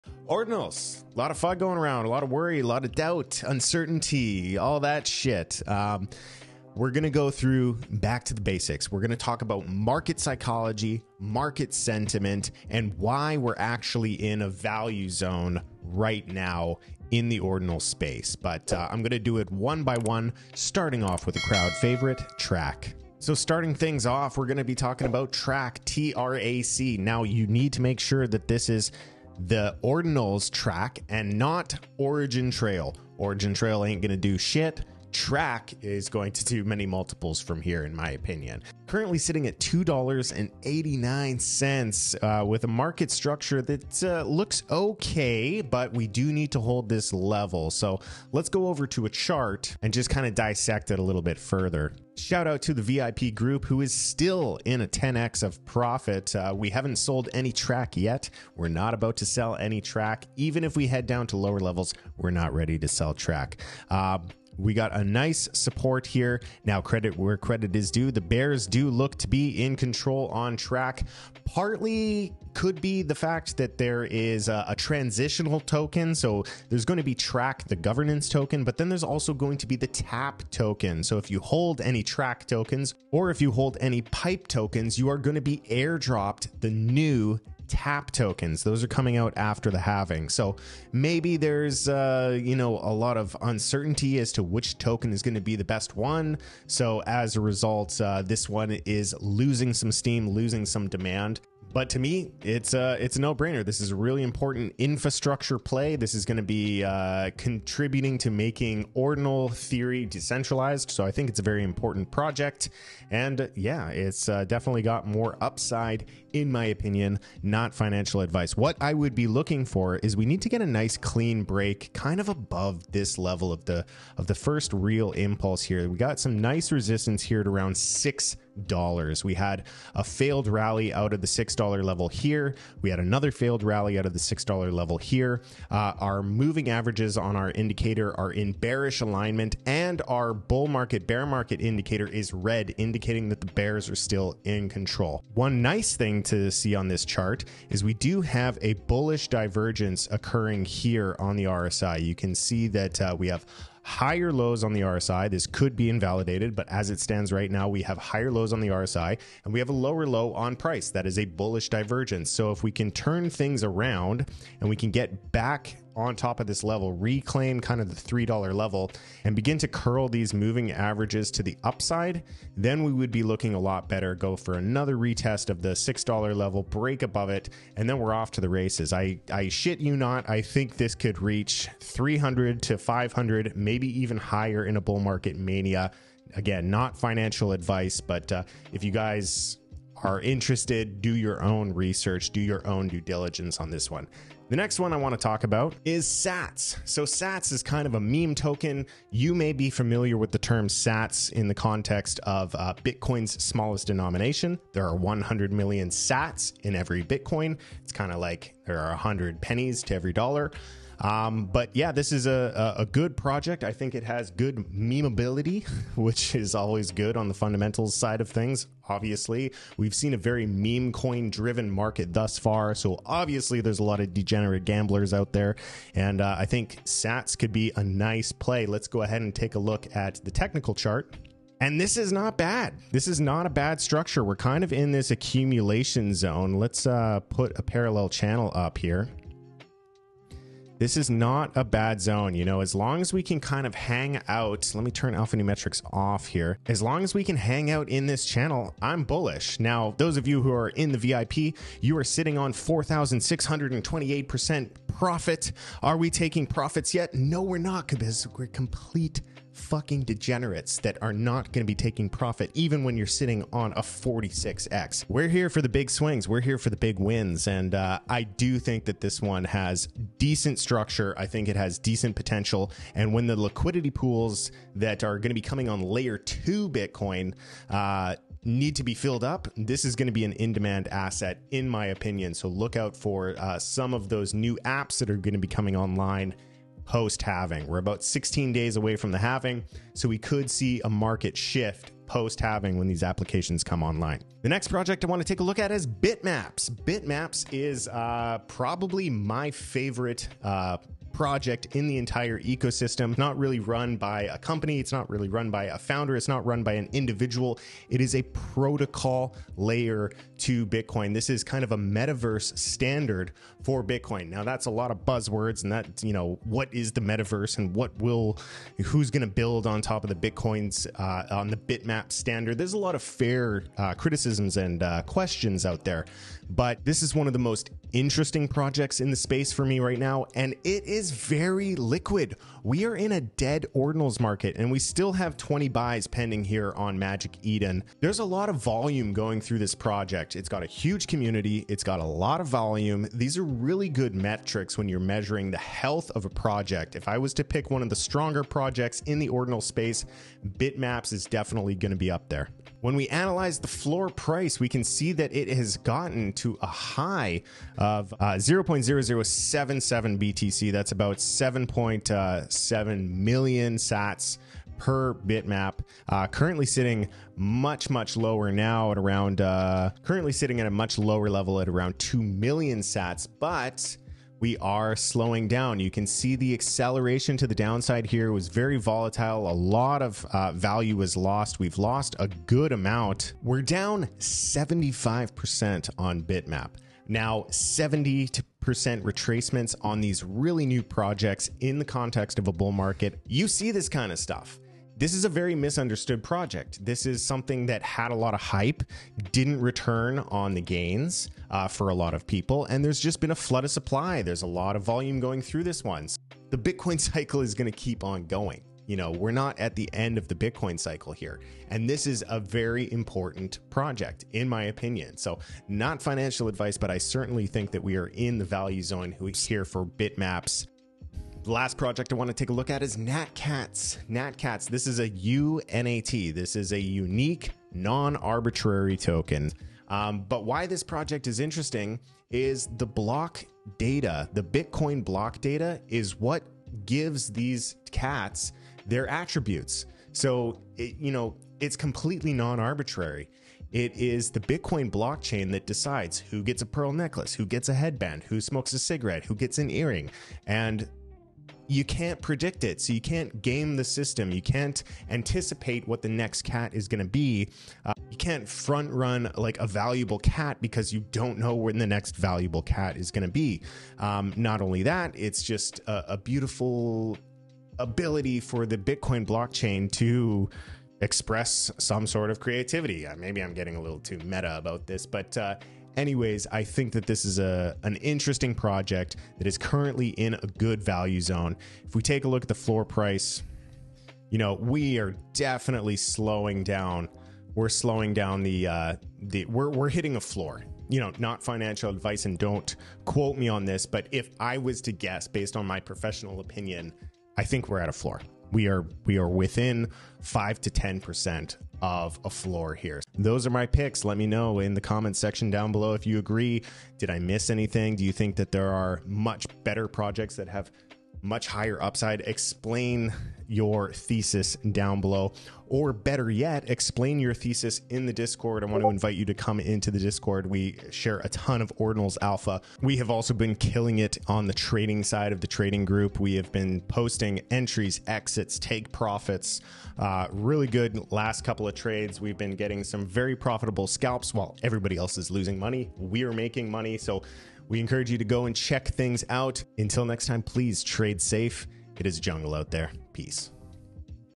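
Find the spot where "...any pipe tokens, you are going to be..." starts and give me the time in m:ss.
1:23.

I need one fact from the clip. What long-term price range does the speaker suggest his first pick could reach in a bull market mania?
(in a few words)
300 to 500.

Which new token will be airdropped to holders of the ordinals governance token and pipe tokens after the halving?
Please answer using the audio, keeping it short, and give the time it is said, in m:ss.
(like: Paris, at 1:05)
tap token, at 1:19.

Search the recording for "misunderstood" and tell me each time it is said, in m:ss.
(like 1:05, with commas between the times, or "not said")
6:35.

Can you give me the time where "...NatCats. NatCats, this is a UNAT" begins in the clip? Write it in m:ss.
7:02.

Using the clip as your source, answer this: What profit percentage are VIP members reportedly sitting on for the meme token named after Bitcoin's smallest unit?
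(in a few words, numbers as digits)
4,628%.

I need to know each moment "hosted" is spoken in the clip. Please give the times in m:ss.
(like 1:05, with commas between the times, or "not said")
not said.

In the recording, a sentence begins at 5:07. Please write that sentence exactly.
It is a protocol layer to Bitcoin.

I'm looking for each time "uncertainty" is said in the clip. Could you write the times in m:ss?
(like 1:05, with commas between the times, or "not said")
0:03, 1:33.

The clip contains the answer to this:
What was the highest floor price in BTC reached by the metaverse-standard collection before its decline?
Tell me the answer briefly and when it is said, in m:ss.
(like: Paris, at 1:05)
0.0077 BTC, at 5:58.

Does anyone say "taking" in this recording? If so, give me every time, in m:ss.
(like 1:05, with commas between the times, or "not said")
4:16, 4:21.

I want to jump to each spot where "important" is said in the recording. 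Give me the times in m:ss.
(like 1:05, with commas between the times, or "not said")
1:44, 1:51, 6:52.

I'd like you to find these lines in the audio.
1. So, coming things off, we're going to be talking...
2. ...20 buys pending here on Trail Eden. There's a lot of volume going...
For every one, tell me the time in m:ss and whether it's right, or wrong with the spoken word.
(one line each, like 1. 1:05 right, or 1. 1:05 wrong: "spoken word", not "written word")
1. 0:23 wrong: "starting", not "coming"
2. 5:35 wrong: "Magic", not "Trail".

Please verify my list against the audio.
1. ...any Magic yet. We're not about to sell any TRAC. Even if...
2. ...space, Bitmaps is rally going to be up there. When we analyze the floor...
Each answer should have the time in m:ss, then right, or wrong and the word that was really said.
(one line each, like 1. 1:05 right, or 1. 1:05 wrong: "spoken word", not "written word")
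1. 0:57 wrong: "TRAC", not "Magic"
2. 5:49 wrong: "definitely", not "rally".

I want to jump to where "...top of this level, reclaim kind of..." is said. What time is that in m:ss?
2:46.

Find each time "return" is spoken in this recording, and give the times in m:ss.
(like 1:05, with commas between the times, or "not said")
6:39.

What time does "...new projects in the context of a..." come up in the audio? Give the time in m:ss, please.
6:30.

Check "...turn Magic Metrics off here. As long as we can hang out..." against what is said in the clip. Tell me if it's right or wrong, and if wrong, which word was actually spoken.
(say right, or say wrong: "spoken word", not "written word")
wrong: "Alpha", not "Magic".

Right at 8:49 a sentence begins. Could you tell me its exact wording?
Uh, really good last couple of trades.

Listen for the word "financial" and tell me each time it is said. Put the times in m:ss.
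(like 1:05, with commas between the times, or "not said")
1:57, 3:06, 6:56, 8:11.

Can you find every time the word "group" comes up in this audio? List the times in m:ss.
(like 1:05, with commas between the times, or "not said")
0:53, 8:45.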